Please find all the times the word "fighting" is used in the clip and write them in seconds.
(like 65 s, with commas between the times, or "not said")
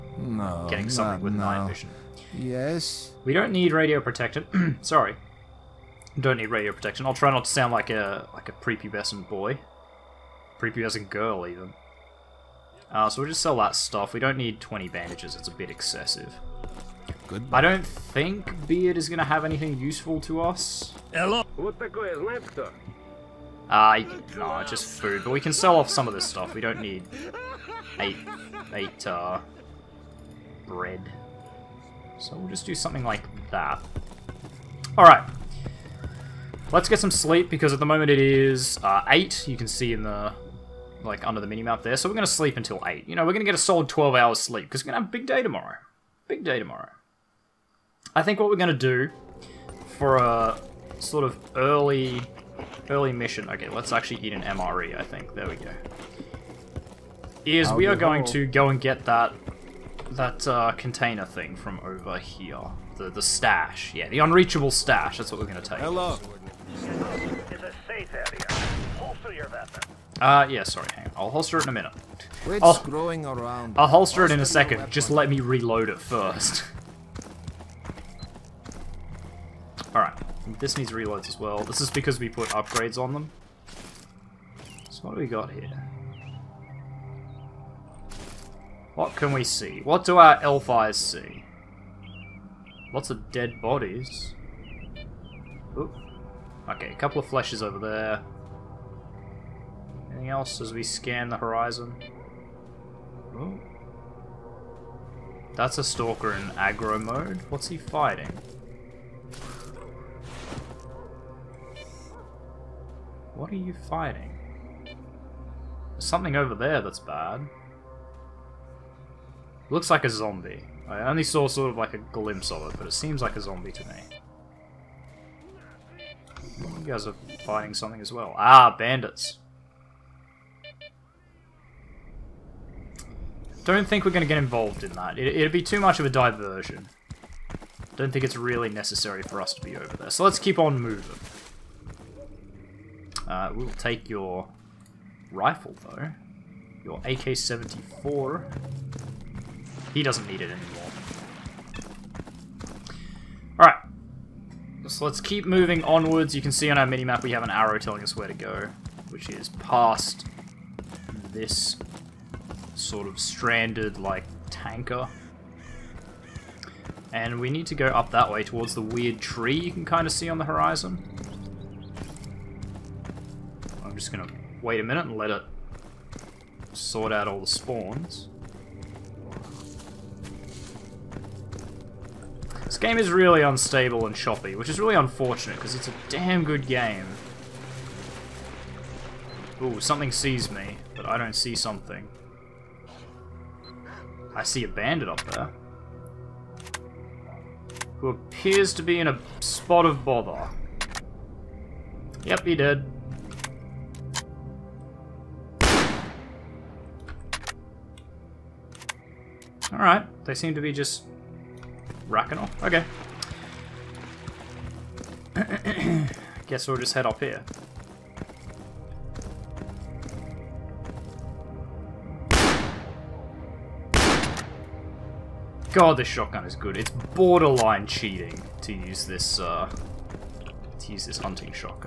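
107 s, 113 s, 127 s.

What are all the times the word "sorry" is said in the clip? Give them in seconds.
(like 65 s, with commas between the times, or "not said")
4 s, 70 s.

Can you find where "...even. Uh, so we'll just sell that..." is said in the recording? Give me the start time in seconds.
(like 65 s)
11 s.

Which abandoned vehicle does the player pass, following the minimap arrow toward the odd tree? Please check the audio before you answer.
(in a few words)
Tanker.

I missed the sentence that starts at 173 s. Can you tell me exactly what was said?
I'm just gonna wait a minute and let it sort out all the spawns.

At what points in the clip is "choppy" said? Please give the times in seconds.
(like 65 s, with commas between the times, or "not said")
184 s.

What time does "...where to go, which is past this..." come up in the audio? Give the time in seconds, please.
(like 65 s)
158 s.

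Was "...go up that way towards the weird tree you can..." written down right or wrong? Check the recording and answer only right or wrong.
right.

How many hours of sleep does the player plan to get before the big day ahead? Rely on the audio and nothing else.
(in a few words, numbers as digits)
12.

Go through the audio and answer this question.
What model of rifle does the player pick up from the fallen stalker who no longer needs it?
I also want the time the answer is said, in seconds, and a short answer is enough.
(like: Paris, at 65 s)
AK-74, at 146 s.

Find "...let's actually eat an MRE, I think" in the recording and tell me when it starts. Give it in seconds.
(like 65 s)
53 s.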